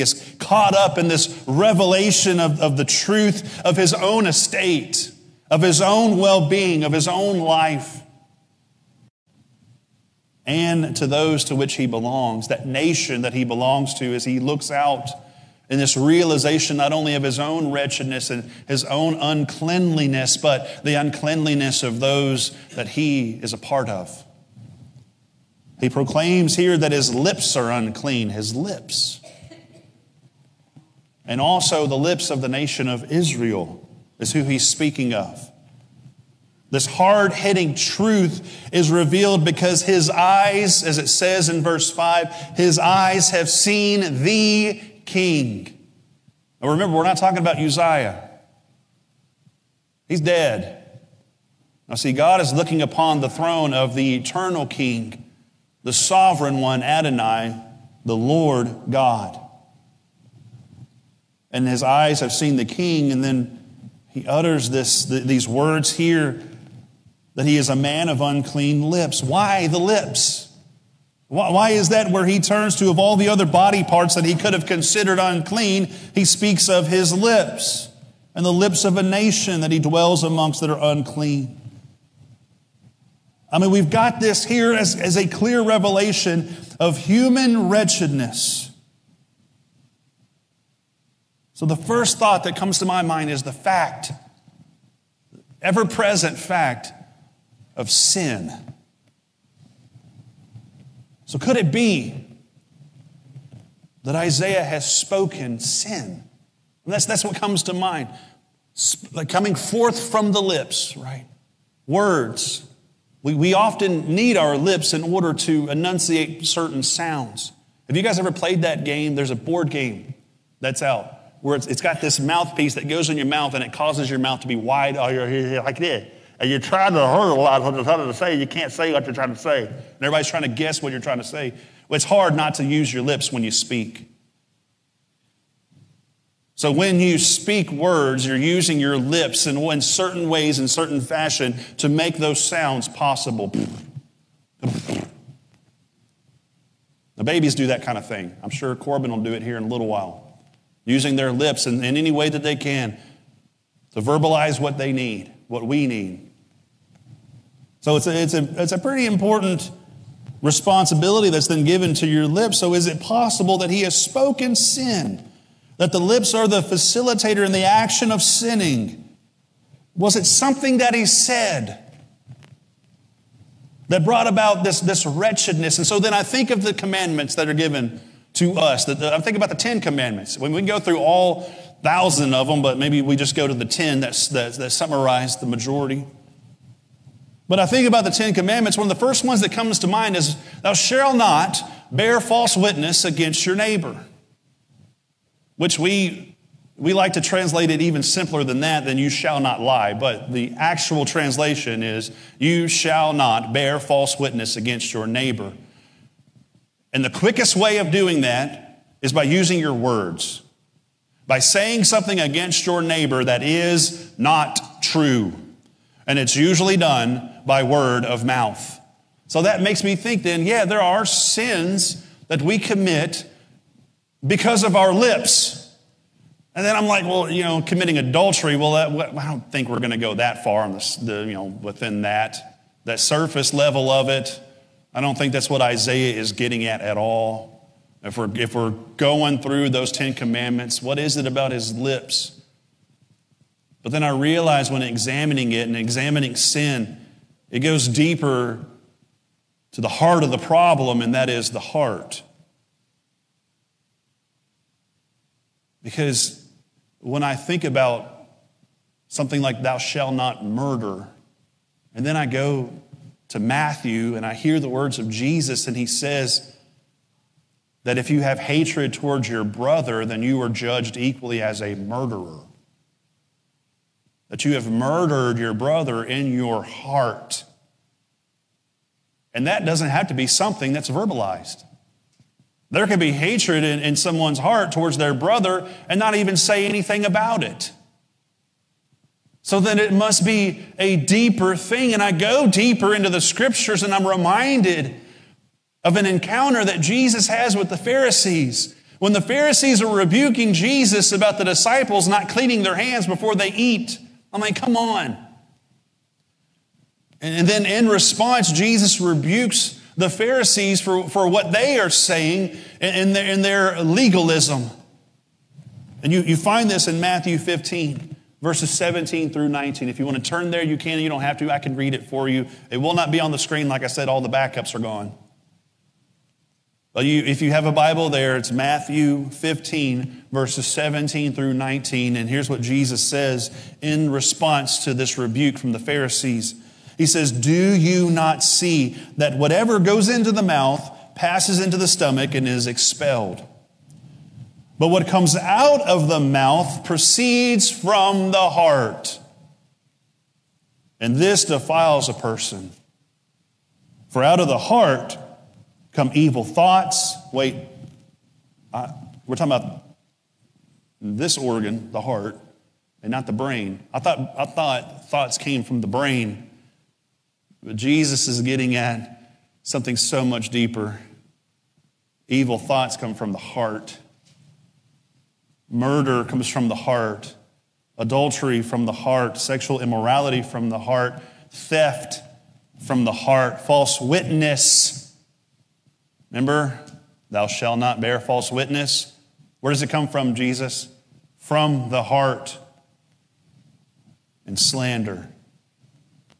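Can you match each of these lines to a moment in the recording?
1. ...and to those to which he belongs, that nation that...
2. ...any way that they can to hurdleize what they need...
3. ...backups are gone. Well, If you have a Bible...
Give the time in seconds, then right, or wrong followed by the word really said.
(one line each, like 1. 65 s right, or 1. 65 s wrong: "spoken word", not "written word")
1. 10 s right
2. 151 s wrong: "verbalize", not "hurdleize"
3. 324 s right.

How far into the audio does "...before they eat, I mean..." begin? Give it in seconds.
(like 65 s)
303 s.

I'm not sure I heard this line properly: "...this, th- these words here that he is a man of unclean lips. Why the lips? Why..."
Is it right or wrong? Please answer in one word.
right.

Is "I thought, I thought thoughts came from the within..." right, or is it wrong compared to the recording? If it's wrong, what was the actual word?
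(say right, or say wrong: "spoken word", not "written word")
wrong: "brain", not "within".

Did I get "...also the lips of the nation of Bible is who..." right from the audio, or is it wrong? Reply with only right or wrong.
wrong.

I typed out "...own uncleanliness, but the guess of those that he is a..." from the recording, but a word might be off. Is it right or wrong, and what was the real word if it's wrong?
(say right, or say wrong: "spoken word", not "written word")
wrong: "uncleanliness", not "guess".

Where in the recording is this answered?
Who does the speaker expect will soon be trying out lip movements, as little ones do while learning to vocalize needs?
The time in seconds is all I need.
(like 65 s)
148 s.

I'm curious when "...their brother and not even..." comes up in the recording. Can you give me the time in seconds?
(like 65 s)
284 s.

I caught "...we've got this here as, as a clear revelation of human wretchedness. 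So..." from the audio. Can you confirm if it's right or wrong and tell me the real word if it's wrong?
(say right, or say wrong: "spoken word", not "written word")
right.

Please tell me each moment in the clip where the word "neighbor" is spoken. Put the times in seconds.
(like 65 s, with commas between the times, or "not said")
193 s, 205 s, 212 s.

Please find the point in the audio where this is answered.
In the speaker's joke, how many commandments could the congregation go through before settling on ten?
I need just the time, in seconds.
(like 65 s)
181 s.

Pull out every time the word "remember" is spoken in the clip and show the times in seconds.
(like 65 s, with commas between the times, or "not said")
46 s, 386 s.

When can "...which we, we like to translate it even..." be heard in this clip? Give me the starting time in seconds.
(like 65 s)
195 s.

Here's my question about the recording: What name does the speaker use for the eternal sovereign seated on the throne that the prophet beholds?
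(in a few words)
Adonai.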